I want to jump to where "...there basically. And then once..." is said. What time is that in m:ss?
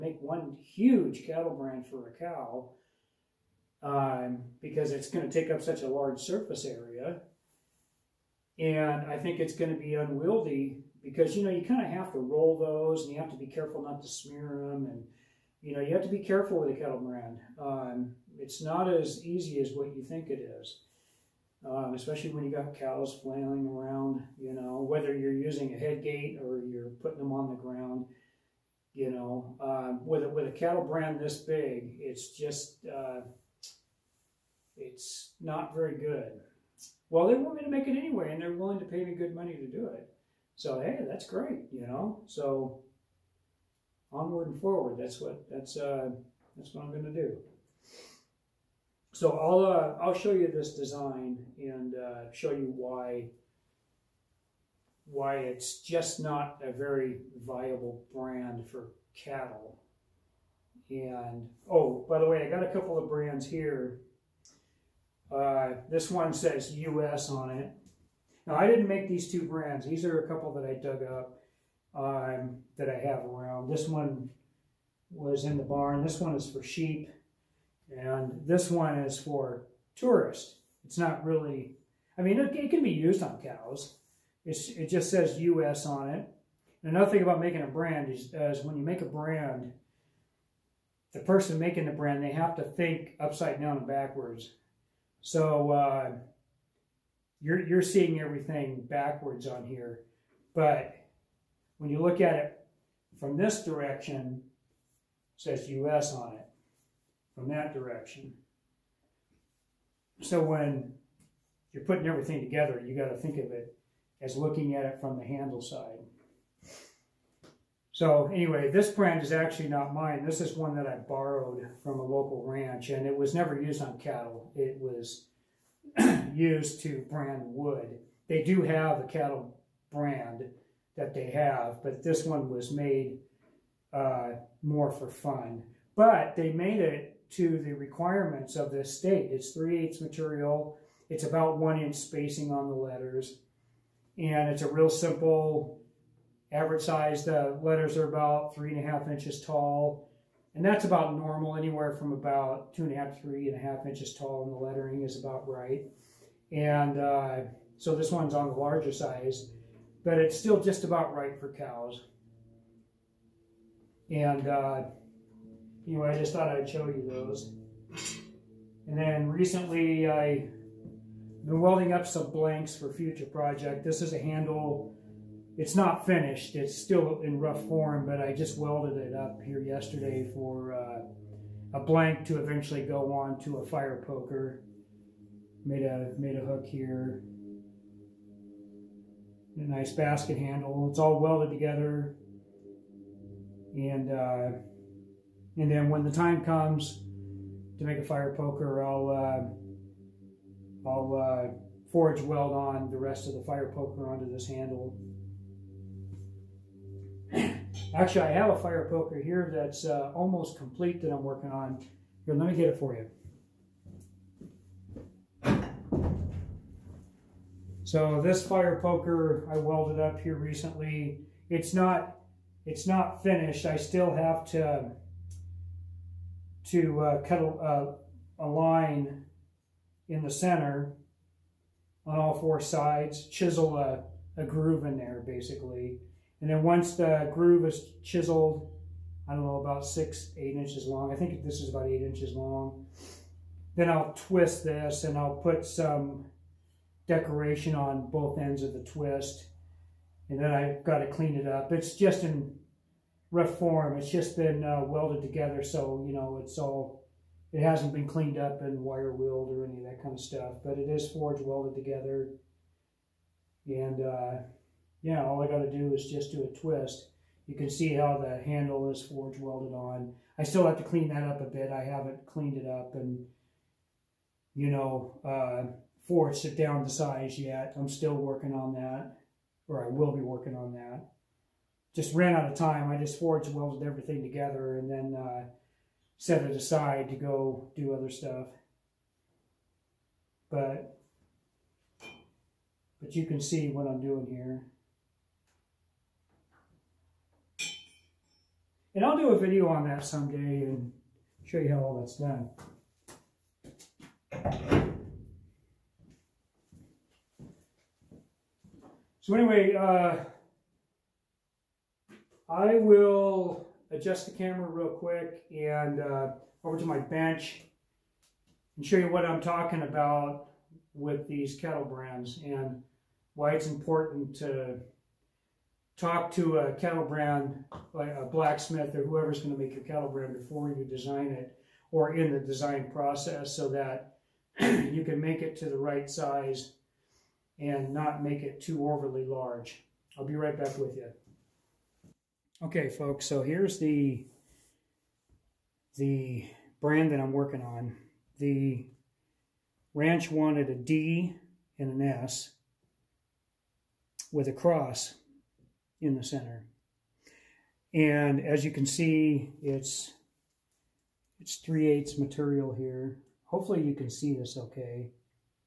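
3:54.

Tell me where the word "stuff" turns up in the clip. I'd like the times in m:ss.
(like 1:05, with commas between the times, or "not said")
4:20, 4:48.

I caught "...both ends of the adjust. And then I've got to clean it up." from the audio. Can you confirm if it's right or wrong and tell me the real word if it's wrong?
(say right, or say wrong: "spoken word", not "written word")
wrong: "twist", not "adjust".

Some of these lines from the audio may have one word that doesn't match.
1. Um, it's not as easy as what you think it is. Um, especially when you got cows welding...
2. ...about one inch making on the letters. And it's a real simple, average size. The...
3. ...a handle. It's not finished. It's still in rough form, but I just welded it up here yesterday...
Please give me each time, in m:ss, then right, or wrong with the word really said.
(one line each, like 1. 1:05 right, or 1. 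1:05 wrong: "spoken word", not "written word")
1. 0:17 wrong: "flailing", not "welding"
2. 2:21 wrong: "spacing", not "making"
3. 2:54 right.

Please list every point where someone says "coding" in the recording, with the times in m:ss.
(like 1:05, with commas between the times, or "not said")
not said.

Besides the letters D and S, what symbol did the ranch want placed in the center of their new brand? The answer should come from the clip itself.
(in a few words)
A cross.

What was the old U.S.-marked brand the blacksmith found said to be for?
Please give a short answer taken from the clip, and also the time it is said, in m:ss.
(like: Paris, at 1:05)
Tourists, at 1:19.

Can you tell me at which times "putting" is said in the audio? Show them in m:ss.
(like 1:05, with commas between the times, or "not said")
0:27, 1:51.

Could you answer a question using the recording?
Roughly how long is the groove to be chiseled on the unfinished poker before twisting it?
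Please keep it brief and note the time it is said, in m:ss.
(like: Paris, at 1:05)
8 inches, at 4:01.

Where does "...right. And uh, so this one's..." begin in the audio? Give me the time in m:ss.
2:35.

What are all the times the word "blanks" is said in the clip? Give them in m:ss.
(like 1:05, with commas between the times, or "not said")
2:52, 3:01.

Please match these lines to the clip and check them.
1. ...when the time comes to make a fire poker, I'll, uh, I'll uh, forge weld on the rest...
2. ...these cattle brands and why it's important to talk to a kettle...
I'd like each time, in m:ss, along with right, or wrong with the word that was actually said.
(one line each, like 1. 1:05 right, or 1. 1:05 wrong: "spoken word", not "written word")
1. 3:15 right
2. 5:21 wrong: "kettle", not "cattle".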